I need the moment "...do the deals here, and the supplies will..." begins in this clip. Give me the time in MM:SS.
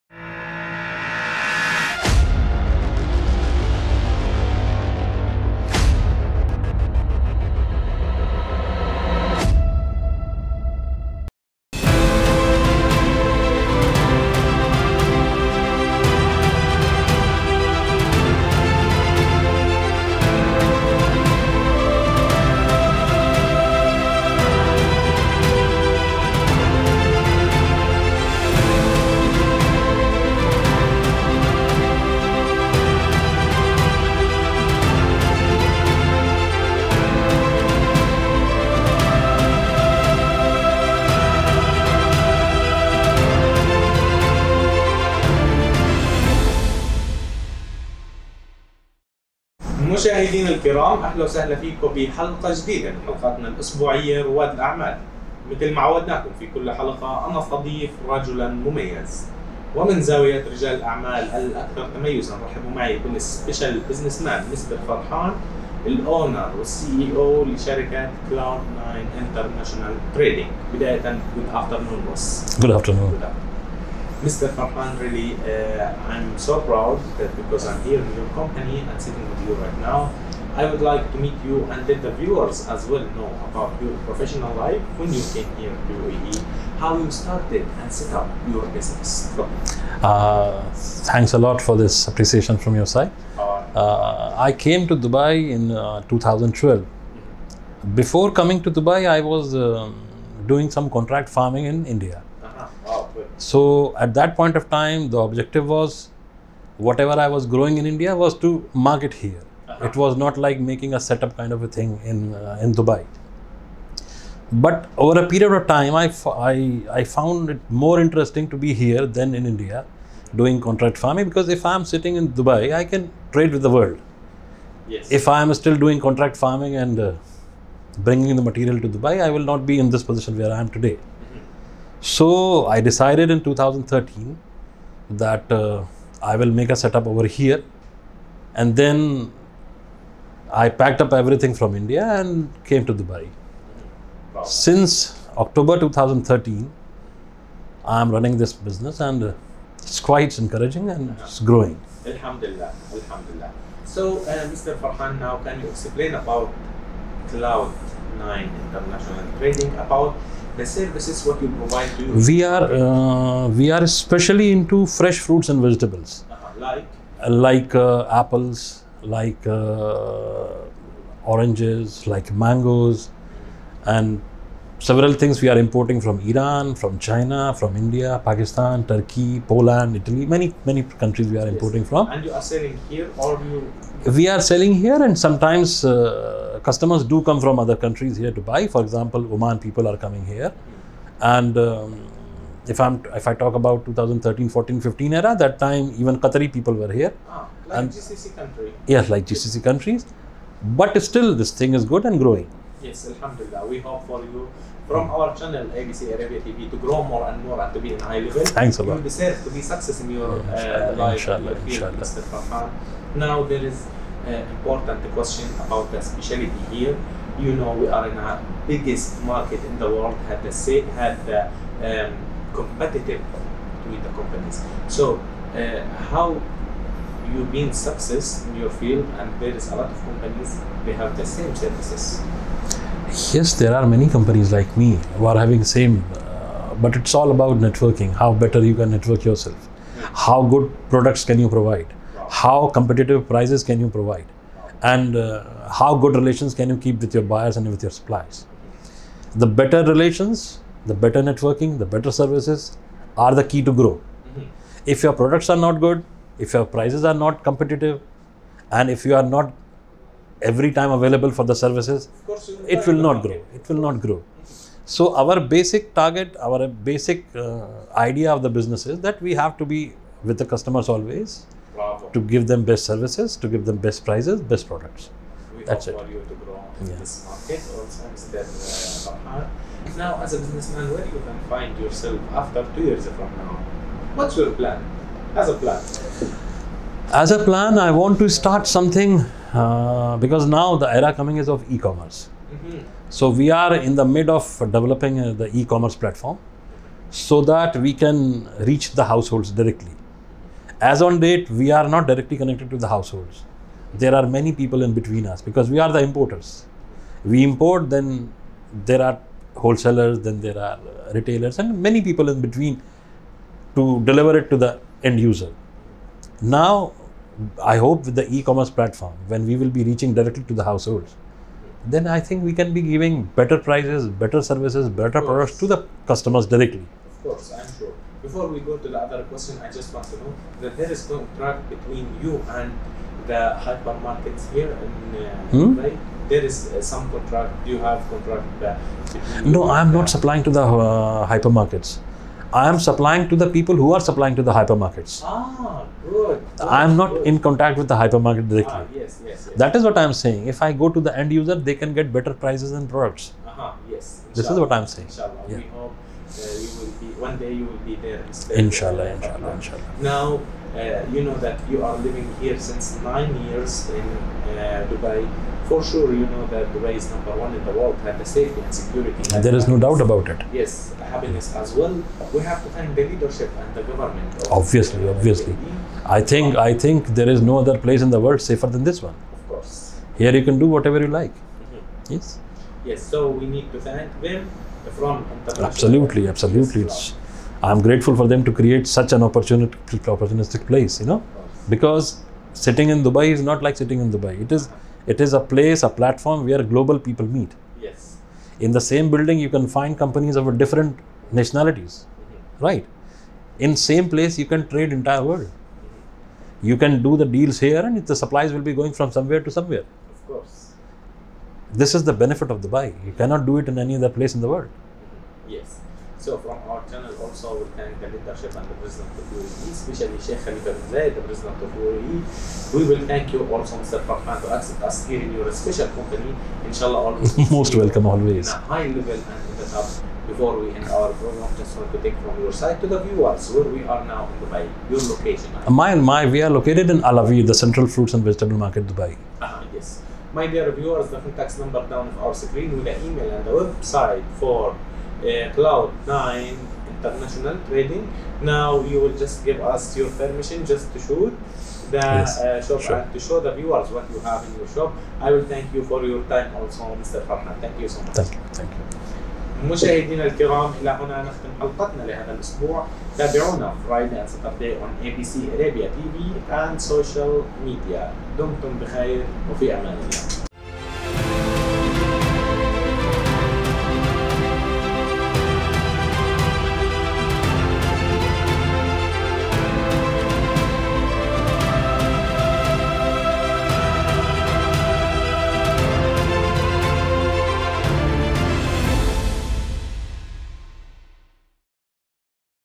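06:47.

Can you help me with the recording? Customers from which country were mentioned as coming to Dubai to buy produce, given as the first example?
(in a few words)
Oman.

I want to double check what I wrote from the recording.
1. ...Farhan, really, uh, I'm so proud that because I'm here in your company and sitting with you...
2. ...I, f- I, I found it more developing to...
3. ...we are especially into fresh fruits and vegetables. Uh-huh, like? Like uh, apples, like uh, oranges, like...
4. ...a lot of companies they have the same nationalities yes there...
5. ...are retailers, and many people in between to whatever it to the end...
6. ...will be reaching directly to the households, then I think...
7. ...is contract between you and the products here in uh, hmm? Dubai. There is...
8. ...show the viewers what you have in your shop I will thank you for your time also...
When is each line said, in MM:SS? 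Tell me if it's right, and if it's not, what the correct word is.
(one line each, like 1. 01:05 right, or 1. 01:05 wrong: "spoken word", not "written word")
1. 01:14 right
2. 01:55 wrong: "interesting", not "developing"
3. 02:43 right
4. 03:49 wrong: "services", not "nationalities"
5. 05:10 wrong: "deliver", not "whatever"
6. 05:19 right
7. 05:30 wrong: "hypermarkets", not "products"
8. 07:33 right.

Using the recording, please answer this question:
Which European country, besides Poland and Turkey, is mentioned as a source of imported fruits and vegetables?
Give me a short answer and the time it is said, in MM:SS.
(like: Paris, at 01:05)
Italy, at 02:59.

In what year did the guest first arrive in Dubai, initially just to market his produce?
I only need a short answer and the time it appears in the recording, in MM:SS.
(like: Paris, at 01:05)
2012, at 01:36.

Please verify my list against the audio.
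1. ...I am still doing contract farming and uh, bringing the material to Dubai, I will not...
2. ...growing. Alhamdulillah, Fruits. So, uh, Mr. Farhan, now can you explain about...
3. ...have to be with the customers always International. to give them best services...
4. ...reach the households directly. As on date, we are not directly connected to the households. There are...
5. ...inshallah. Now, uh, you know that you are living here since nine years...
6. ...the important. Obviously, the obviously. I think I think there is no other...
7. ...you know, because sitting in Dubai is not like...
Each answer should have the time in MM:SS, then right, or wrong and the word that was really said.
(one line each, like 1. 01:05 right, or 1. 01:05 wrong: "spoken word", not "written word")
1. 02:05 right
2. 02:31 wrong: "Alhamdulillah", not "Fruits"
3. 04:29 wrong: "Bravo", not "International"
4. 04:58 right
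5. 05:59 right
6. 06:13 wrong: "government", not "important"
7. 06:30 right.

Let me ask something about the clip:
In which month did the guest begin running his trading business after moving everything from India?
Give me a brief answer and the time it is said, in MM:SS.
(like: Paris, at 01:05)
October, at 02:25.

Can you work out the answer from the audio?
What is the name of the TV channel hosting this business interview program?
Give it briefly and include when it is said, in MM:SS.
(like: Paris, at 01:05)
ABC Arabia TV, at 03:25.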